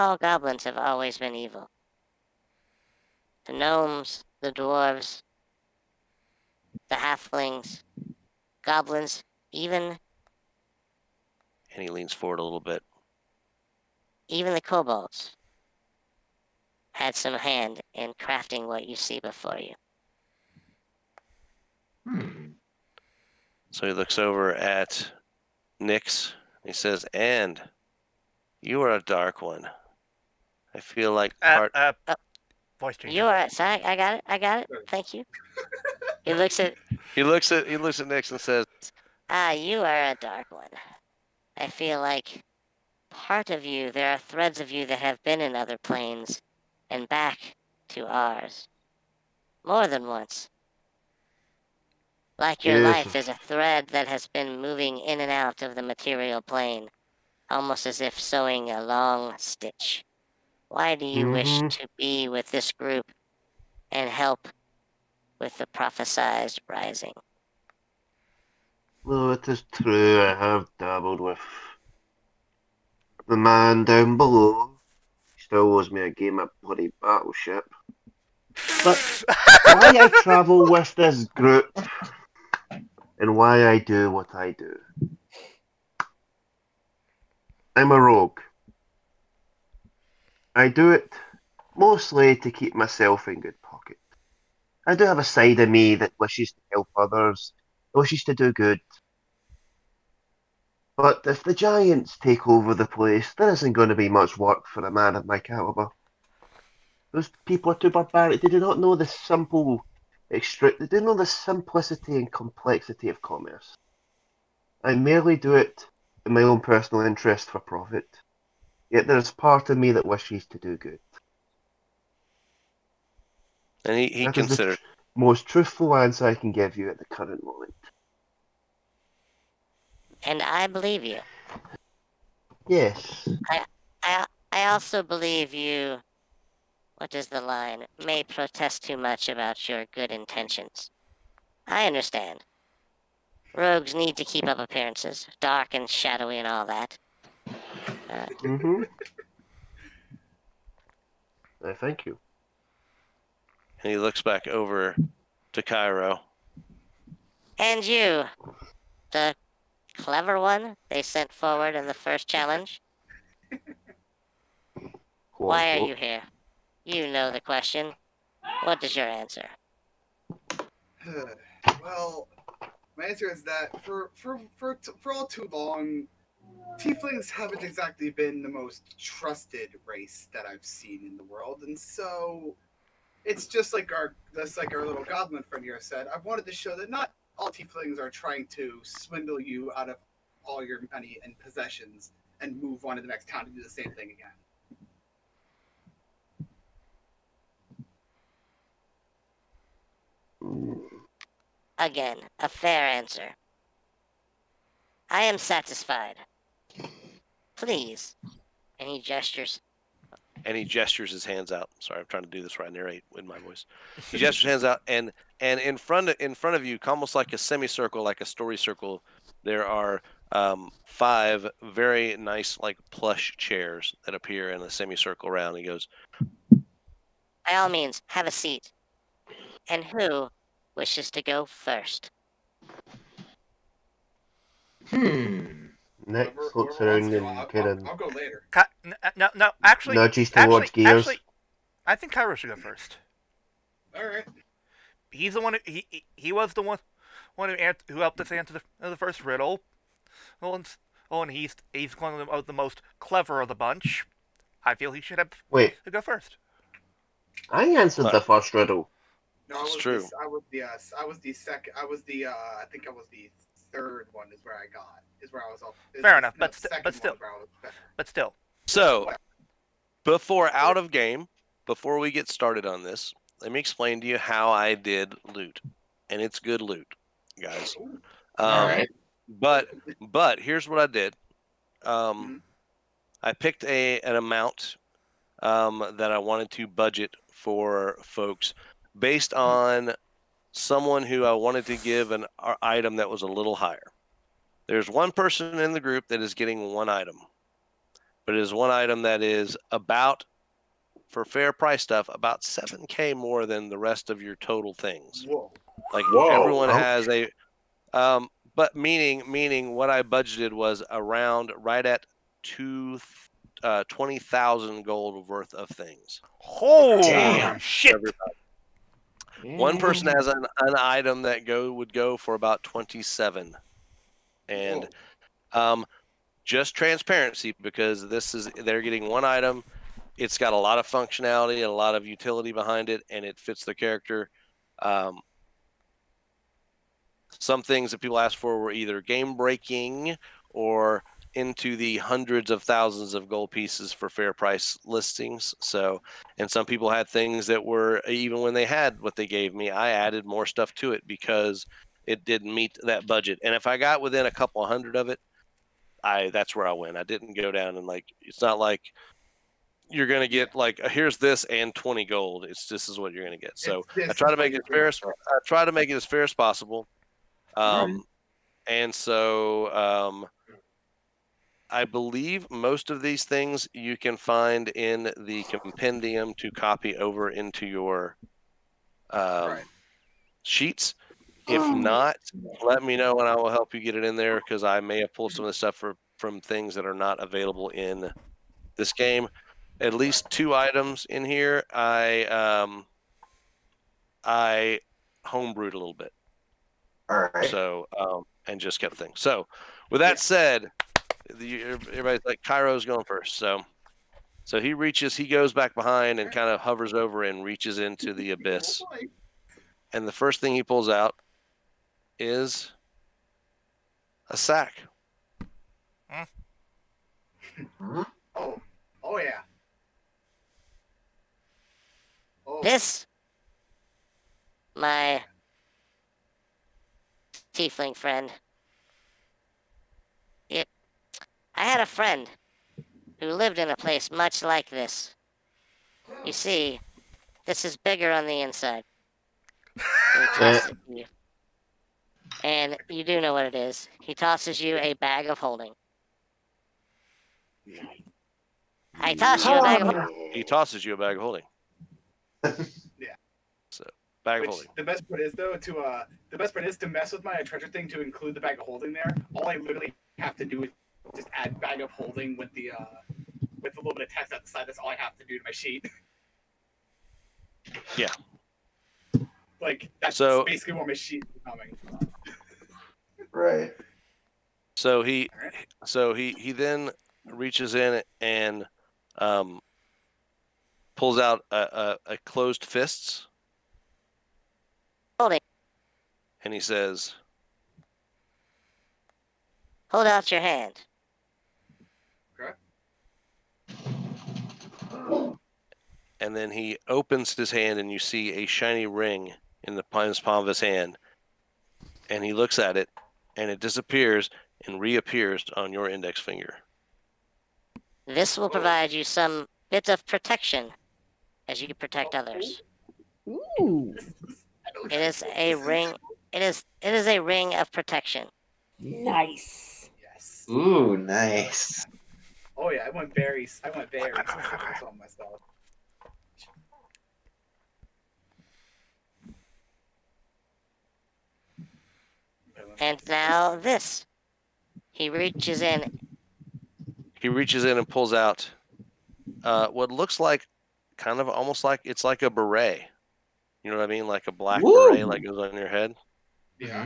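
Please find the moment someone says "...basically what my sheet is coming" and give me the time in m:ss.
7:50.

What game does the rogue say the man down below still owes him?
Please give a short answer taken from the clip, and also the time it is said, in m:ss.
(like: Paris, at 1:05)
Battleship, at 1:16.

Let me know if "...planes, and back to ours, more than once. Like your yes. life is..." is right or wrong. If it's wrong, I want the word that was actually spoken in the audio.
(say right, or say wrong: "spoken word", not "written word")
right.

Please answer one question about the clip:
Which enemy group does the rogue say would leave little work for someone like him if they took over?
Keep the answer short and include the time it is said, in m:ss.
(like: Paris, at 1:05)
The Giants, at 1:41.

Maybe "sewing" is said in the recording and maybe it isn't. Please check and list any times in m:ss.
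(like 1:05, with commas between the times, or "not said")
0:58.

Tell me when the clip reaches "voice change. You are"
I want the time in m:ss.
0:32.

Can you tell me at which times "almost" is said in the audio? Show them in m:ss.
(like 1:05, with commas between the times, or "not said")
0:57, 3:36, 9:01.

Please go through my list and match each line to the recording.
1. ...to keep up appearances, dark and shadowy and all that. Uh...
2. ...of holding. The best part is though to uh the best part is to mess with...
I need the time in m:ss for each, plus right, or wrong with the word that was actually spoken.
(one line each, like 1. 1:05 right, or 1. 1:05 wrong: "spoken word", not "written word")
1. 2:24 right
2. 7:34 right.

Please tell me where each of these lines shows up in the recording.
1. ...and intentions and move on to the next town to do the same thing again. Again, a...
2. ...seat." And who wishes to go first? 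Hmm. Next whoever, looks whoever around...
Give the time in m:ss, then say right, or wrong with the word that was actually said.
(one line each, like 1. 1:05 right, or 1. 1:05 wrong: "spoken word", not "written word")
1. 3:11 wrong: "possessions", not "intentions"
2. 3:48 right.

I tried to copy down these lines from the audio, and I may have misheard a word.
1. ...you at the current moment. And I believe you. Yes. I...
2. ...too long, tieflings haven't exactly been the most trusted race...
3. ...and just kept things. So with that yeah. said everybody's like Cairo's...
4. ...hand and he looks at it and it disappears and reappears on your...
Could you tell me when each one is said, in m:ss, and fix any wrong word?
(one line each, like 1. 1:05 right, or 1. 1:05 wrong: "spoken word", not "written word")
1. 2:06 right
2. 2:55 right
3. 6:38 right
4. 8:20 right.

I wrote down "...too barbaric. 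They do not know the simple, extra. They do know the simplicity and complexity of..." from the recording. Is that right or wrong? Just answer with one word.
right.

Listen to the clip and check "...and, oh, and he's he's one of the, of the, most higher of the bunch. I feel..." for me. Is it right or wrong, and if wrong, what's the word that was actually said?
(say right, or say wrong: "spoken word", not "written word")
wrong: "clever", not "higher".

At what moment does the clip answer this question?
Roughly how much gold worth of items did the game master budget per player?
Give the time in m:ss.
5:13.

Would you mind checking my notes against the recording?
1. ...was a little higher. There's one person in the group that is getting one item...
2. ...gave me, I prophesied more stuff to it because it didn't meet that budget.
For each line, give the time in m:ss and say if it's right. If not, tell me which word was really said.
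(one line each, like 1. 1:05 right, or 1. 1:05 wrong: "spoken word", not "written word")
1. 4:53 right
2. 5:49 wrong: "added", not "prophesied".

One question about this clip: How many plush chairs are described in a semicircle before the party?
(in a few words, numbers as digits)
5.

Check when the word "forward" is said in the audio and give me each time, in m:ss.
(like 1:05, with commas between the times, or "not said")
0:12, 2:41.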